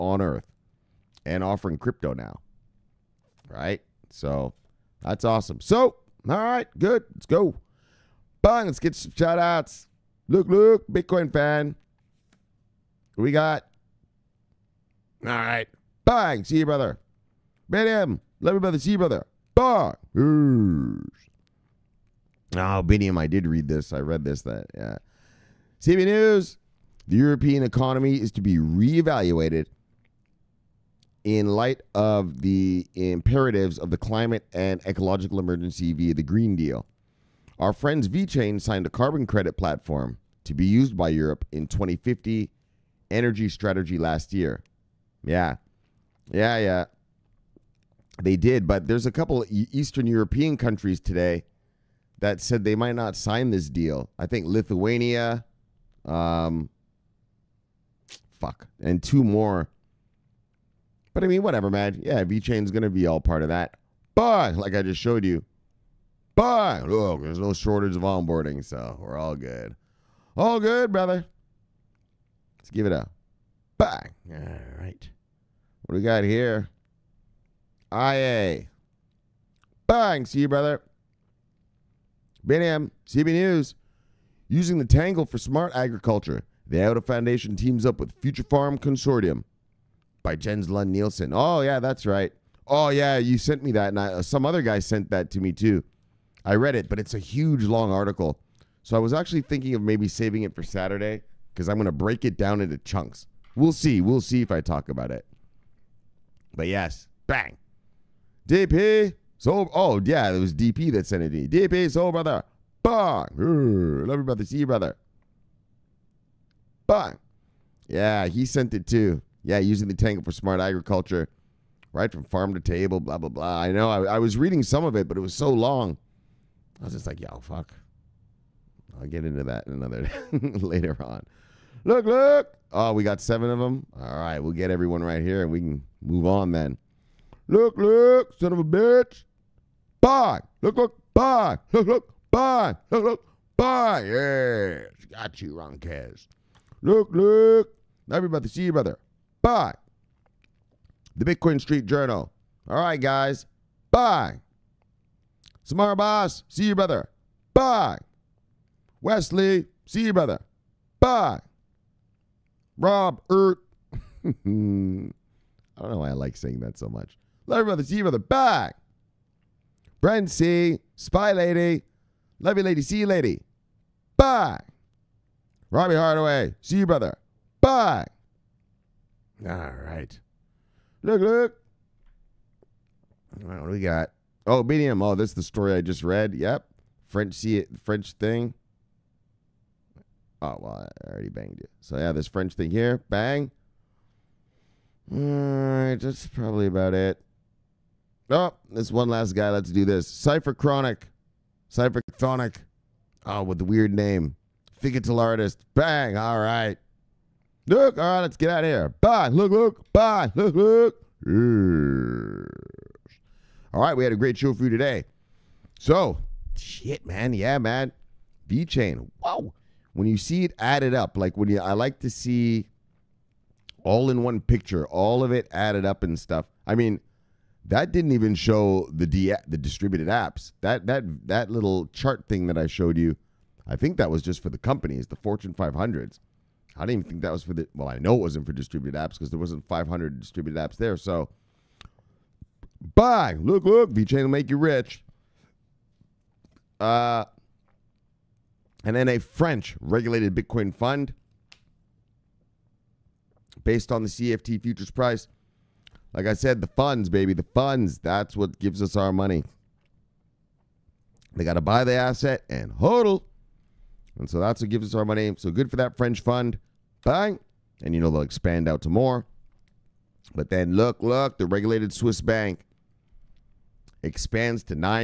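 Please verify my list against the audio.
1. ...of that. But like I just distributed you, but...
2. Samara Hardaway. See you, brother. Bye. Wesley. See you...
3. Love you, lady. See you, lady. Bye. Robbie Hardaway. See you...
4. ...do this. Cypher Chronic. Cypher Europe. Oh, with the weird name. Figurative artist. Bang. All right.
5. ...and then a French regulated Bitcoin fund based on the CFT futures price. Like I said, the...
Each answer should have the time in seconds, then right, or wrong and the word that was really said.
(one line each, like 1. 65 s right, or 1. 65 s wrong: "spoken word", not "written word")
1. 63 s wrong: "showed", not "distributed"
2. 155 s wrong: "Boss", not "Hardaway"
3. 172 s right
4. 199 s wrong: "Chronic", not "Europe"
5. 248 s right.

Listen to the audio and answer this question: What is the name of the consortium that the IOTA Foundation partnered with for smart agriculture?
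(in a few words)
Future Farm Consortium.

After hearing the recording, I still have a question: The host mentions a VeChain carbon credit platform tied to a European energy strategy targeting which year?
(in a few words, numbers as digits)
2050.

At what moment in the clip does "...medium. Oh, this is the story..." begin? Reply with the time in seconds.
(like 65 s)
184 s.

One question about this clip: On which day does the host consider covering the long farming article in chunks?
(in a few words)
Saturday.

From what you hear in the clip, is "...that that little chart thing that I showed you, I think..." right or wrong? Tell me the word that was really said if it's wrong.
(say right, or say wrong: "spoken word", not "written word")
right.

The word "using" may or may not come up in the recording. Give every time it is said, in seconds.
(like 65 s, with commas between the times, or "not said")
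84 s, 119 s.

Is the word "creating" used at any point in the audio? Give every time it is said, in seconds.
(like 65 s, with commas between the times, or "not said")
not said.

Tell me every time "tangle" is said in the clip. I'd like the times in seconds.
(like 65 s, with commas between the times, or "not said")
84 s, 119 s.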